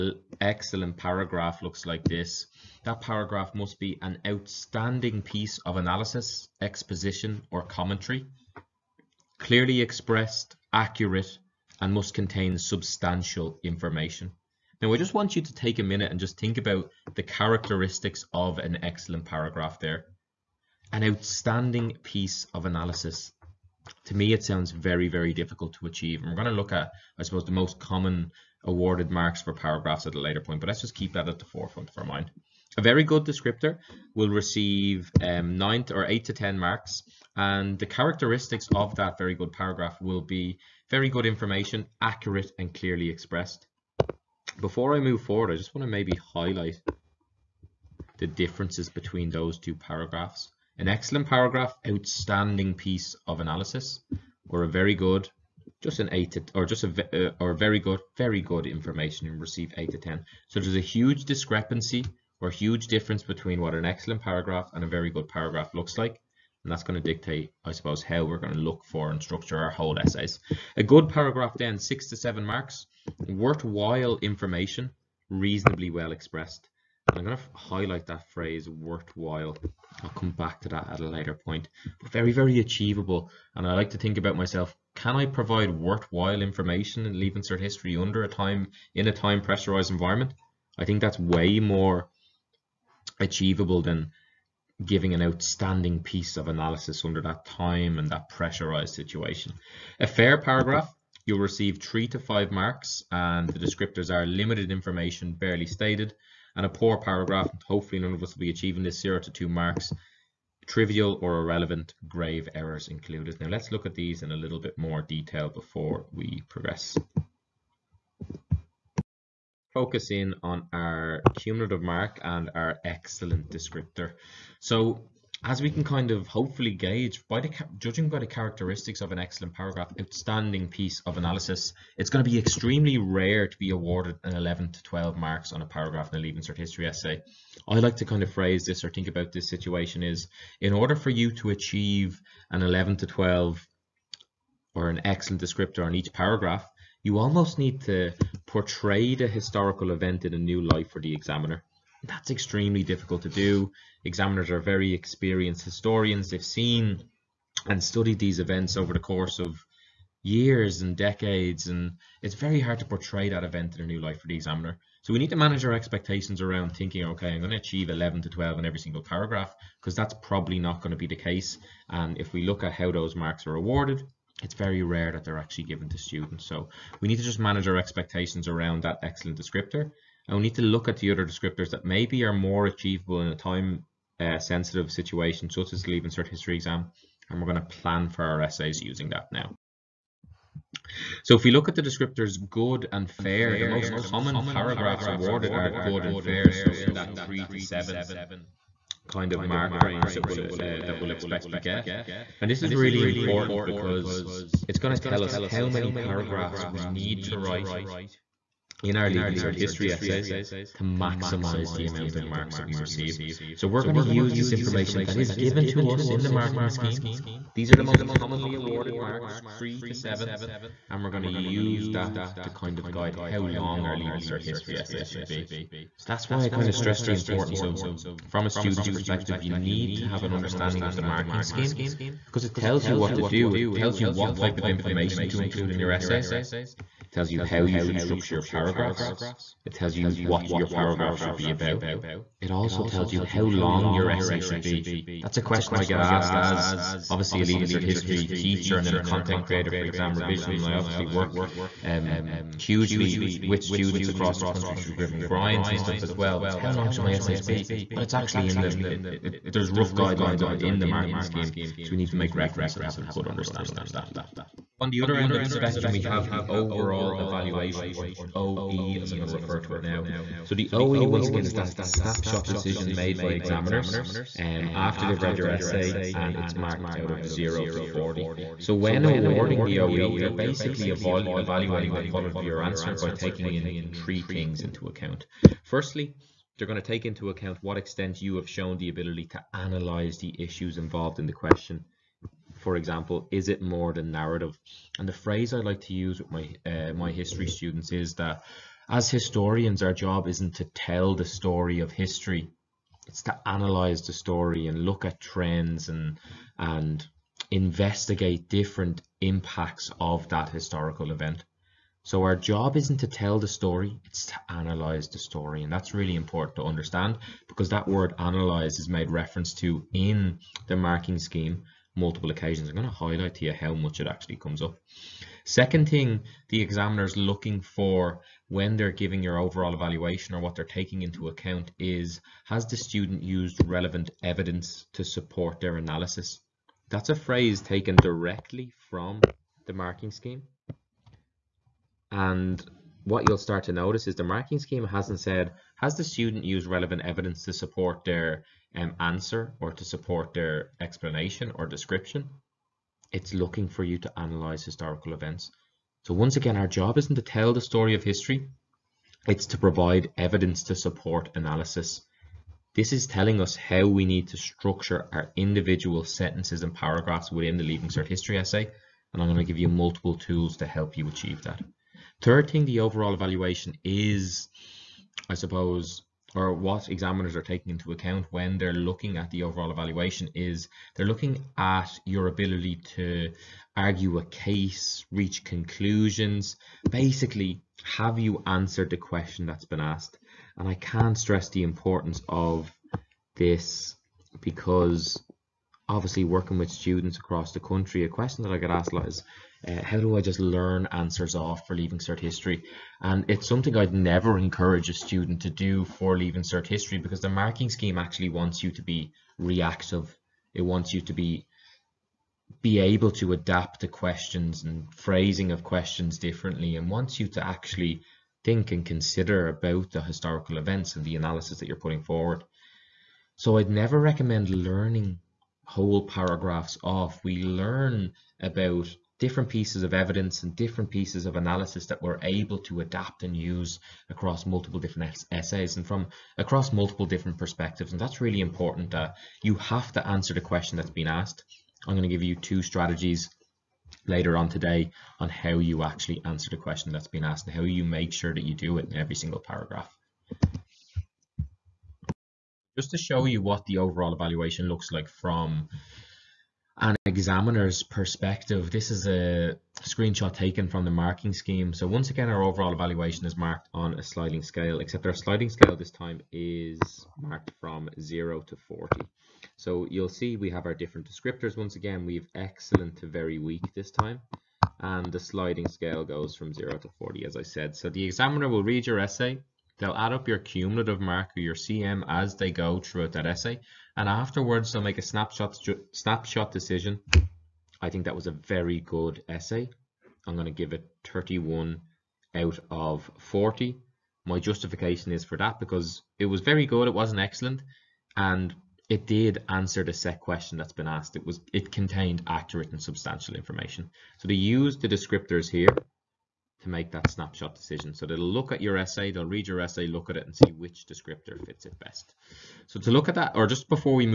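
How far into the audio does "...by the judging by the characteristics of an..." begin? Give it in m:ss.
2:07.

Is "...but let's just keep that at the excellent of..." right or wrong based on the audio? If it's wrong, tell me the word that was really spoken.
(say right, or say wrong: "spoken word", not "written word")
wrong: "forefront", not "excellent".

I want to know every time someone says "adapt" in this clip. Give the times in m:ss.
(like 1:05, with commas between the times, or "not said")
6:53, 7:12.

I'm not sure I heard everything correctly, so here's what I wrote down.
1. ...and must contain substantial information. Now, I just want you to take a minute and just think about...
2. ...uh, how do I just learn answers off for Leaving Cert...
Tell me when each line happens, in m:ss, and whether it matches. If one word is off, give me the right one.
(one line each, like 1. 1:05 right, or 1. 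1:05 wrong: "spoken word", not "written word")
1. 0:11 right
2. 6:39 right.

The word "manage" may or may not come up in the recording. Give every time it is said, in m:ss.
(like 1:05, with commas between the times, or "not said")
2:45, 2:57.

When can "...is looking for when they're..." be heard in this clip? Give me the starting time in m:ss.
5:27.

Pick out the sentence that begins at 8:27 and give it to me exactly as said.
So they'll look at your essay, they'll read your essay, look at it and see which descriptor fits it best.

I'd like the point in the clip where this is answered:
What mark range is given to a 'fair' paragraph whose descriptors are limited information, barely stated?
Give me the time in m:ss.
1:41.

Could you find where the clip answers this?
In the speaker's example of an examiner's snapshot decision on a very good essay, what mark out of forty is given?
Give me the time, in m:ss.
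8:11.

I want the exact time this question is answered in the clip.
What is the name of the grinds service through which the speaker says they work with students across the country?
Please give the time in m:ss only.
4:14.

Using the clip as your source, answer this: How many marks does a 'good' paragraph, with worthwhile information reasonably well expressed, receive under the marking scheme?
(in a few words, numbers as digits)
6 to 7.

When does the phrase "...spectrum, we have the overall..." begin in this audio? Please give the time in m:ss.
4:25.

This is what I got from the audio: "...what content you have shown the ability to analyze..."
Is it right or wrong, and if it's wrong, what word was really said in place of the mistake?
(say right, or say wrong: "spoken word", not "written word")
wrong: "extent", not "content".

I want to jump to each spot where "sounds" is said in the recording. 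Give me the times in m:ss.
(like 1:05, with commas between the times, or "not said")
0:24.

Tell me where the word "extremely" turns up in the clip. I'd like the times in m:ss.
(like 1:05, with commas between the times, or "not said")
2:12, 2:32.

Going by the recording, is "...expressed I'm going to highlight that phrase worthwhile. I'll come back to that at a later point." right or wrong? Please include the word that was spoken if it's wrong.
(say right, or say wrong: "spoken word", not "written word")
right.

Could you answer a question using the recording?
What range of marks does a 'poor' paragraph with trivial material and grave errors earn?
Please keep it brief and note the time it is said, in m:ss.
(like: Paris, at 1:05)
0 to 2, at 1:49.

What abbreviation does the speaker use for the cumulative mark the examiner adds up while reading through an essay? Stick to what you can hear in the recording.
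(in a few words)
CM.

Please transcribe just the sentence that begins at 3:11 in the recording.
So if we look at the descriptors good and fair, the most common paragraphs awarded are good and fair.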